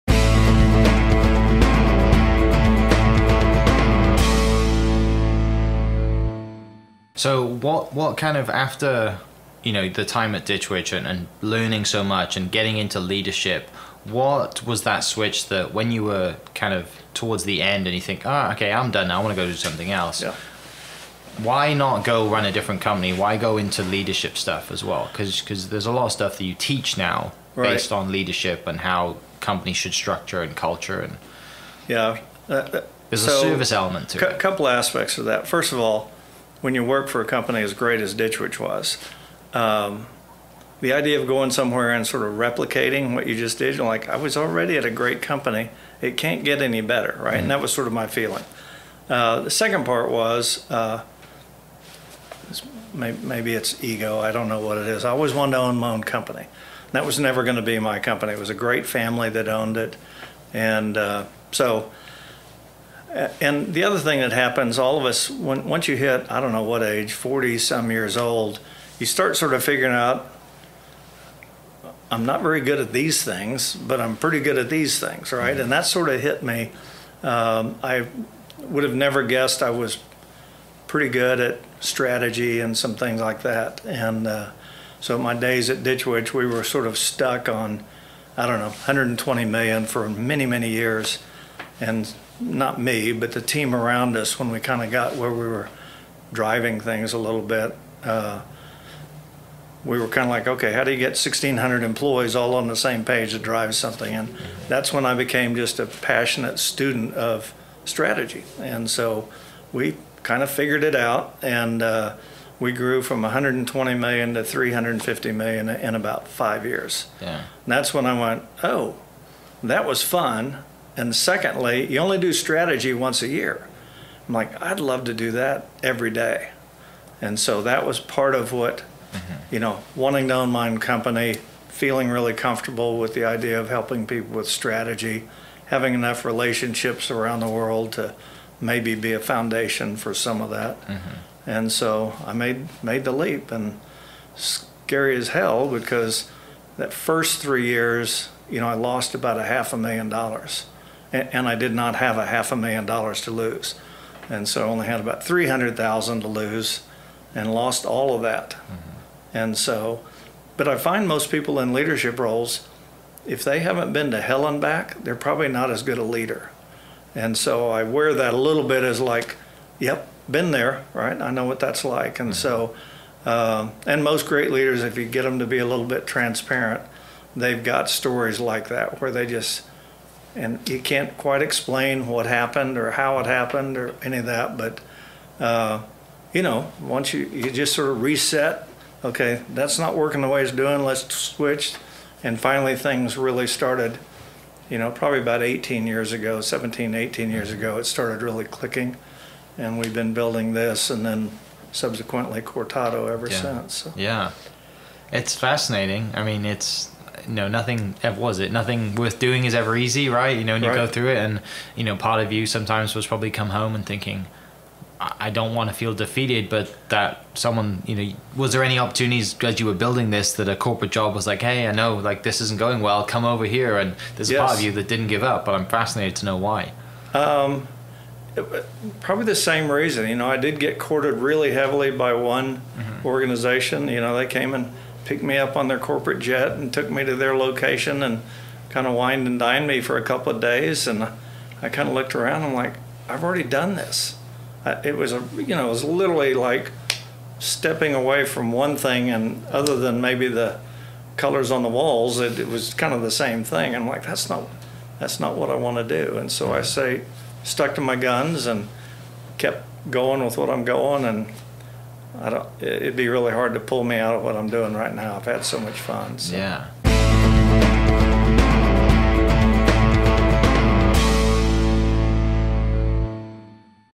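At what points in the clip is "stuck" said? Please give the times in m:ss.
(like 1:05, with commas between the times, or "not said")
1:26, 4:17.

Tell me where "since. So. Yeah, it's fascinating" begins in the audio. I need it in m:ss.
3:23.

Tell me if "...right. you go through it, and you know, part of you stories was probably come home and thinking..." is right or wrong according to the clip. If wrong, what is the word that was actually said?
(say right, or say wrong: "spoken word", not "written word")
wrong: "sometimes", not "stories".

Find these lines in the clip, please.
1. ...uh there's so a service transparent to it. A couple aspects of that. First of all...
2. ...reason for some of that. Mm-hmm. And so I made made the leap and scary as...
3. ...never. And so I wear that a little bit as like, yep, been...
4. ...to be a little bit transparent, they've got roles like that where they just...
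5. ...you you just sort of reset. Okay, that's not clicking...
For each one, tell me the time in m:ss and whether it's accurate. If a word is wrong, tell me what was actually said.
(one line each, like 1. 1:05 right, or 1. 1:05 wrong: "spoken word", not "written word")
1. 0:32 wrong: "element", not "transparent"
2. 2:19 wrong: "foundation", not "reason"
3. 2:46 wrong: "leader", not "never"
4. 2:55 wrong: "stories", not "roles"
5. 3:07 wrong: "working", not "clicking".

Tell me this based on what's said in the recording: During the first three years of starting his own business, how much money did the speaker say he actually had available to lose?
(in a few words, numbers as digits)
$300,000.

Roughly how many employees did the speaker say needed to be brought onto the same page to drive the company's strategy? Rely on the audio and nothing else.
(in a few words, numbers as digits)
1,600.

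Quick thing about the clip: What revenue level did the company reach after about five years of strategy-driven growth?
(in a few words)
$350 million.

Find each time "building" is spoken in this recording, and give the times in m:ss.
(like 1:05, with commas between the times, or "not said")
3:20, 3:39.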